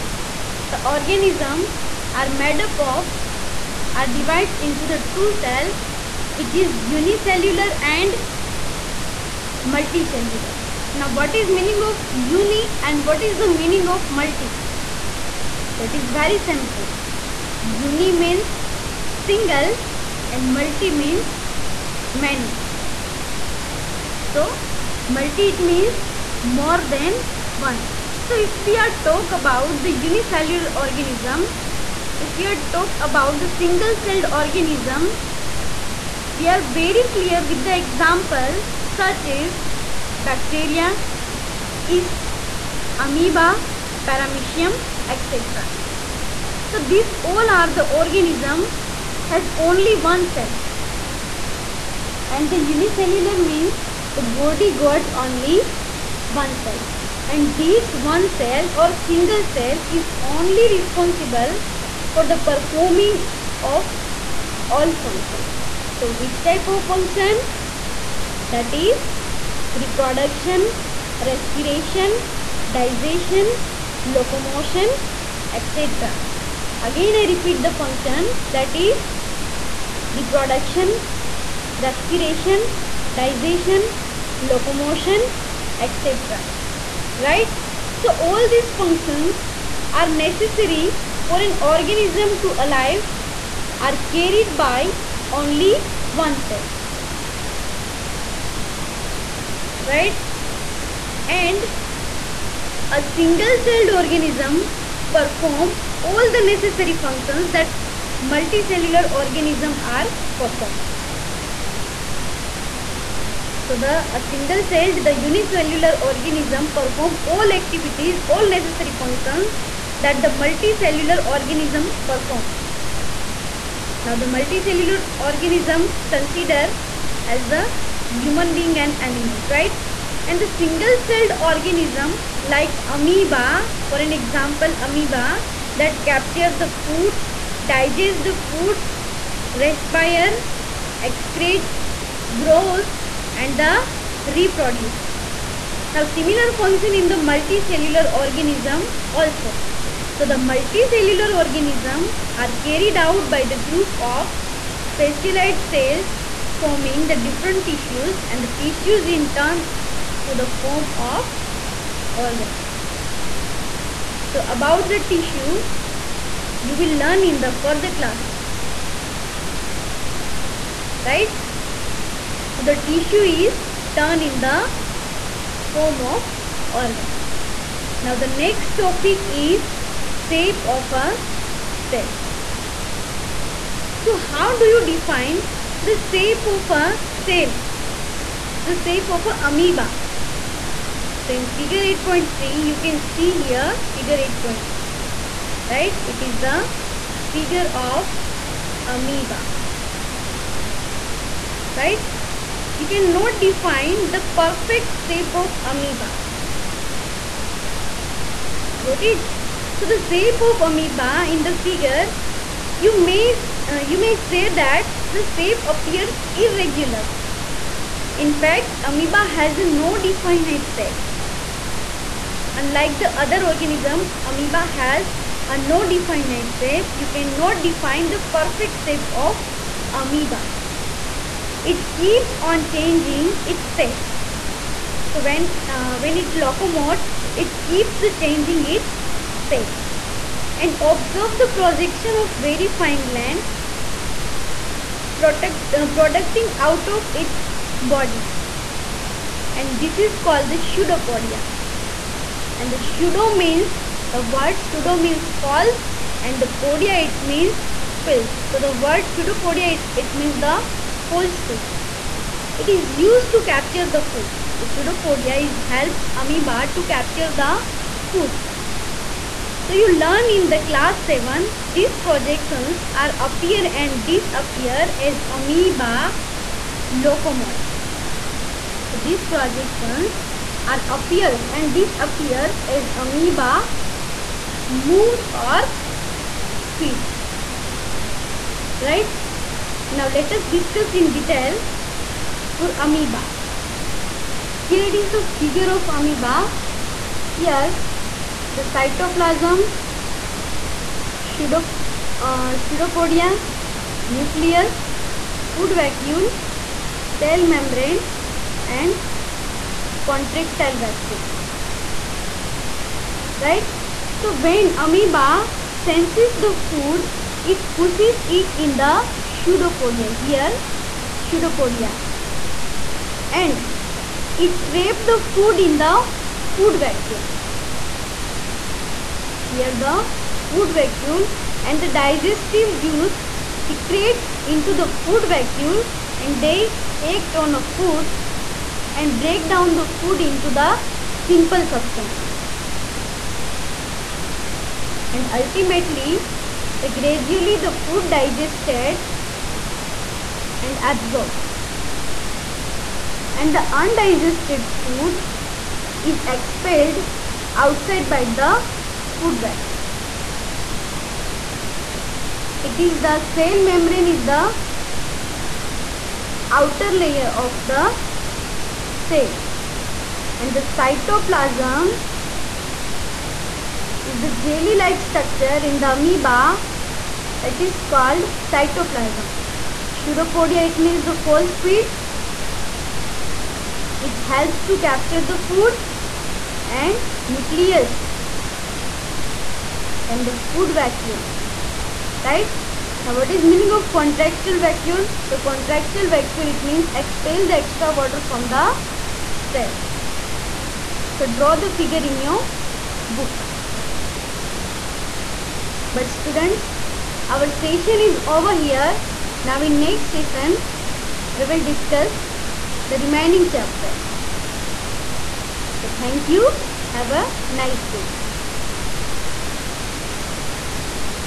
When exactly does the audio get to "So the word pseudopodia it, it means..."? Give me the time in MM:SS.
04:18.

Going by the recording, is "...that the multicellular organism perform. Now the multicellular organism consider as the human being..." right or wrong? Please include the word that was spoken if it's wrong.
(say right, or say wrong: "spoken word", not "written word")
right.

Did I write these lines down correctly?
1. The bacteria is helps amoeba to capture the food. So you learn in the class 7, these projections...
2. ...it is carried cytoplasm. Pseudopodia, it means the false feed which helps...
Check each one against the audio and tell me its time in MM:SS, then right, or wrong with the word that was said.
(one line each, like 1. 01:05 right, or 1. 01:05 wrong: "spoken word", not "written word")
1. 04:24 wrong: "pseudopodia", not "bacteria"
2. 06:17 wrong: "called", not "carried".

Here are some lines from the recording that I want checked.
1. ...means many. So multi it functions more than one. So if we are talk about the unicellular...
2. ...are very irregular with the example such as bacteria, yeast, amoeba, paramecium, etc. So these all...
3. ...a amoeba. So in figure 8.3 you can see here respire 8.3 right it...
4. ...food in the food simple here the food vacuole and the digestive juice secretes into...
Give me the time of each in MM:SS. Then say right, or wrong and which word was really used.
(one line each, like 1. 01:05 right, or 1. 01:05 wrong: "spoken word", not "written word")
1. 00:20 wrong: "means", not "functions"
2. 00:36 wrong: "clear", not "irregular"
3. 03:09 wrong: "figure", not "respire"
4. 05:25 wrong: "vacuole", not "simple".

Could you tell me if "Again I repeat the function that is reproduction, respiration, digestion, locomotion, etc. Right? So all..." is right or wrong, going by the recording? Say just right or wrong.
right.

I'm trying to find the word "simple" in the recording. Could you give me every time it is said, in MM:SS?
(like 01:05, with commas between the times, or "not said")
00:16, 05:41.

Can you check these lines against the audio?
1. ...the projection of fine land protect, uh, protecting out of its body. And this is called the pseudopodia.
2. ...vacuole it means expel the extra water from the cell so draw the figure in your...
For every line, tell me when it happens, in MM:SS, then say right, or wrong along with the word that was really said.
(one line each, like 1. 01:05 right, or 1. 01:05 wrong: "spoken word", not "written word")
1. 04:01 right
2. 06:36 right.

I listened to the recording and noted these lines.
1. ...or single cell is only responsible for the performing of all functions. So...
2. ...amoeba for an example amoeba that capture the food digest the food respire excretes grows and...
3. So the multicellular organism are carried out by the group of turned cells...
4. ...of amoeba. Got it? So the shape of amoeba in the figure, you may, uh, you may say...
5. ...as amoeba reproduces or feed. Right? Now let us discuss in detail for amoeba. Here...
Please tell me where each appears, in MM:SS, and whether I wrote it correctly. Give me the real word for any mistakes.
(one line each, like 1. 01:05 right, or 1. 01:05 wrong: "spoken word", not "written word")
1. 00:58 right
2. 02:12 right
3. 02:30 wrong: "specialized", not "turned"
4. 03:25 right
5. 04:42 wrong: "moves", not "reproduces".